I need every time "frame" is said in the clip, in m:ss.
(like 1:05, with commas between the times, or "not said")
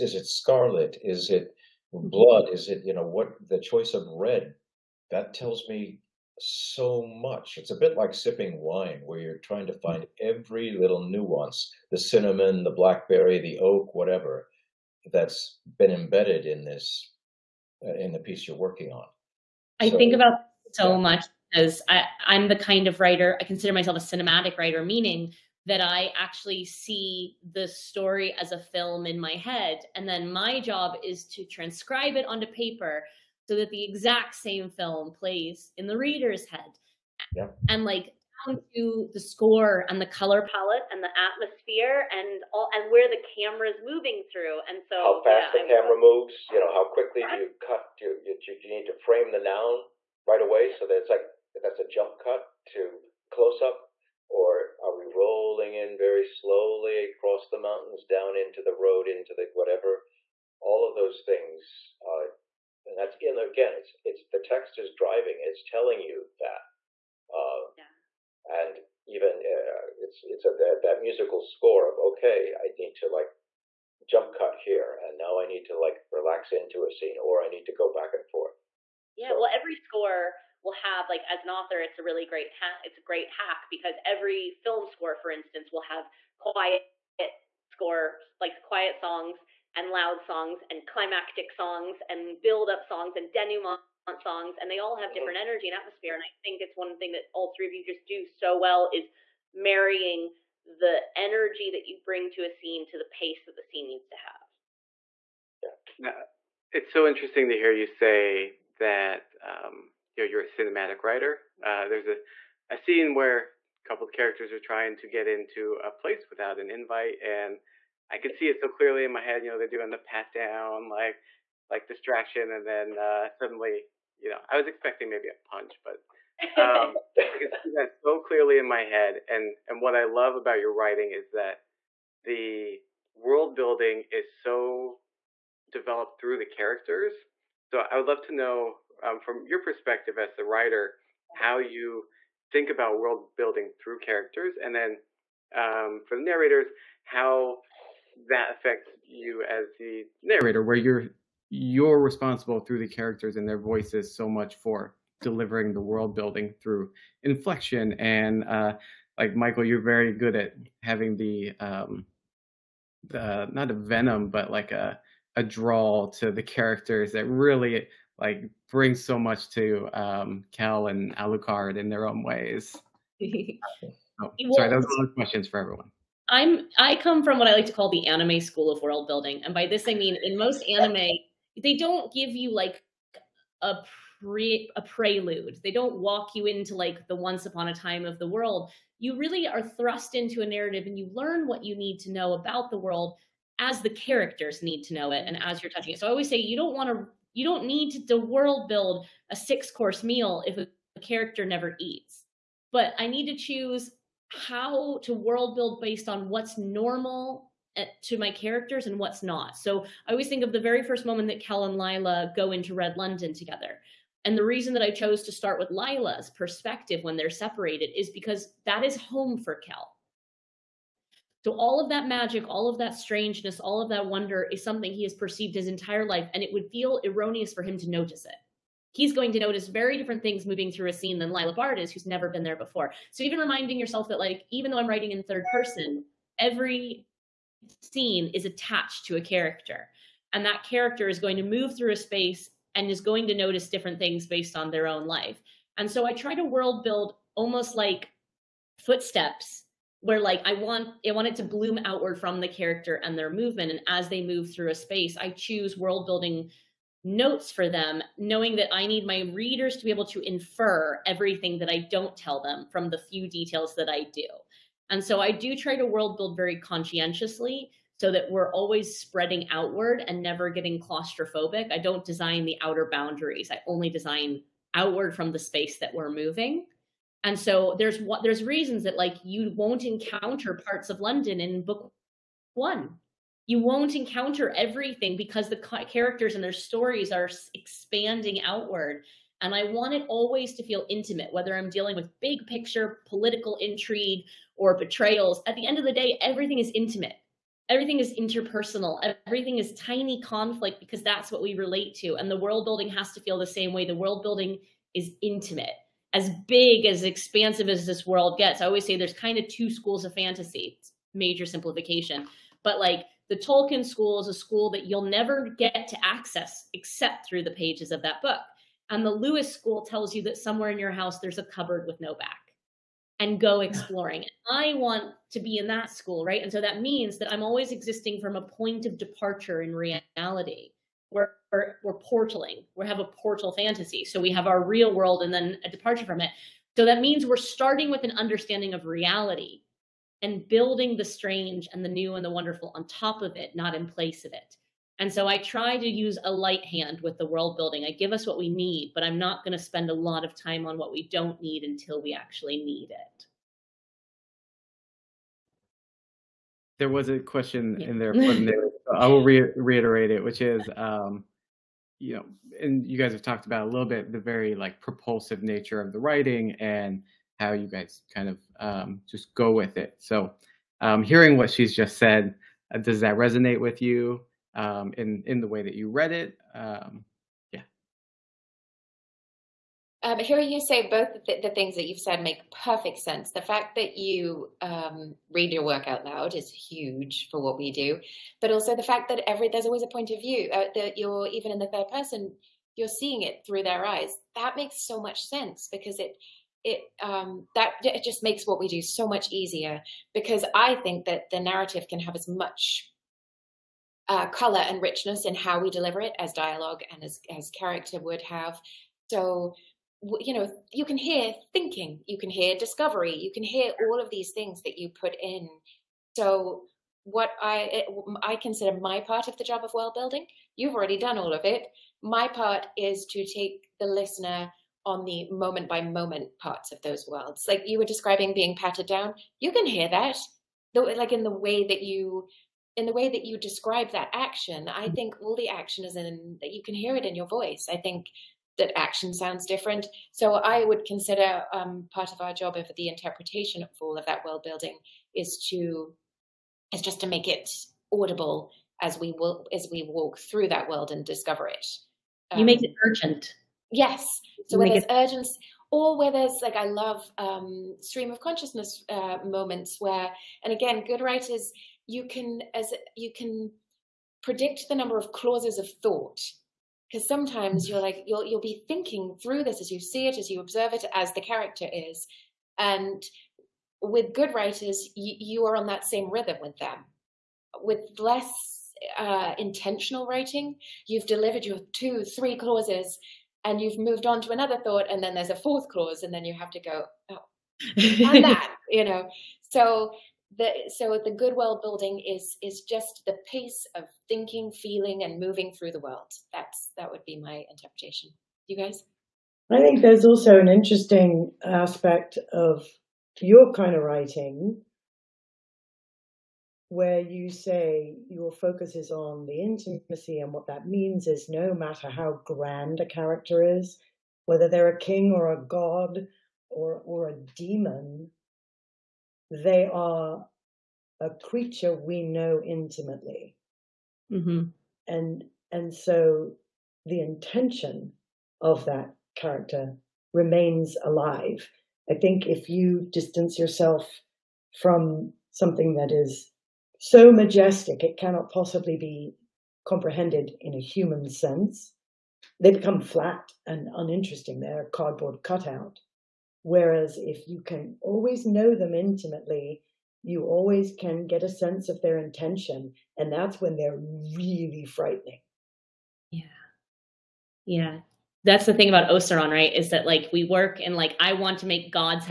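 0:48.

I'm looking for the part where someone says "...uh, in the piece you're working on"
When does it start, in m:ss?
0:17.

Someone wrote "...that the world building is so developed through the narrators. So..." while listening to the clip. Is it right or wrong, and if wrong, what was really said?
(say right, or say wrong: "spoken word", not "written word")
wrong: "characters", not "narrators".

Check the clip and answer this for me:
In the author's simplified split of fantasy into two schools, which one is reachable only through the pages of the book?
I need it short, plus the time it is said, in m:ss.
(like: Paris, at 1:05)
Tolkien School, at 5:13.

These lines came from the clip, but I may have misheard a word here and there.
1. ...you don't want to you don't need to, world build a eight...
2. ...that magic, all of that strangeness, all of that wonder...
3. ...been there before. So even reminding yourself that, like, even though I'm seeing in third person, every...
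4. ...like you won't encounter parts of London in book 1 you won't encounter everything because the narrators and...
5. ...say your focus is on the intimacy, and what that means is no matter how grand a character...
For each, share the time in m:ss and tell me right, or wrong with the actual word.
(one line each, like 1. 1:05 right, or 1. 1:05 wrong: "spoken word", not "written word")
1. 3:16 wrong: "six", not "eight"
2. 3:41 right
3. 3:52 wrong: "writing", not "seeing"
4. 4:38 wrong: "characters", not "narrators"
5. 8:27 right.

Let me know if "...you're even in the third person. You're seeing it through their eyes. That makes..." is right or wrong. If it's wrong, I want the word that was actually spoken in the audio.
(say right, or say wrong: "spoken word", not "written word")
right.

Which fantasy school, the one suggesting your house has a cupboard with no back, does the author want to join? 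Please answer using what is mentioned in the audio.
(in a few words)
Lewis School.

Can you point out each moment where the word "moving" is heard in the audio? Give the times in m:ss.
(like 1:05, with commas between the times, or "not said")
0:43, 3:50, 4:36, 8:15.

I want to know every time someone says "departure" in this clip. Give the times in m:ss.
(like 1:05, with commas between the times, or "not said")
5:28, 5:35.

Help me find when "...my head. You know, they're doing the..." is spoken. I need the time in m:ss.
1:59.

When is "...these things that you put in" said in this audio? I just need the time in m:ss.
6:54.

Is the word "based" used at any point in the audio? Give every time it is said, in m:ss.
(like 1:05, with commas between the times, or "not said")
3:25, 4:04.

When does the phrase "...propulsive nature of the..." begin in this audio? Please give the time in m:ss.
6:04.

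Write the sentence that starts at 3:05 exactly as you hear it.
They don't walk you into like the once upon a time of the world.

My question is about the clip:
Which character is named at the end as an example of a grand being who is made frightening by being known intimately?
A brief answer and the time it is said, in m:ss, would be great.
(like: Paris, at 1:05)
Osaron, at 9:18.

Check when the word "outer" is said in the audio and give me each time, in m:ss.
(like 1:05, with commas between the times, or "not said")
4:32.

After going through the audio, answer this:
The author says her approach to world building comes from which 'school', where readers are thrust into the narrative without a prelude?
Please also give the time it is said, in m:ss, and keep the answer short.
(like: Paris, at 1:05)
anime school, at 2:58.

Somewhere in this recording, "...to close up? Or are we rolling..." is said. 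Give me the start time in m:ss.
0:52.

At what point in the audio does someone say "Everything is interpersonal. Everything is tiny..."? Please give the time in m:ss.
4:57.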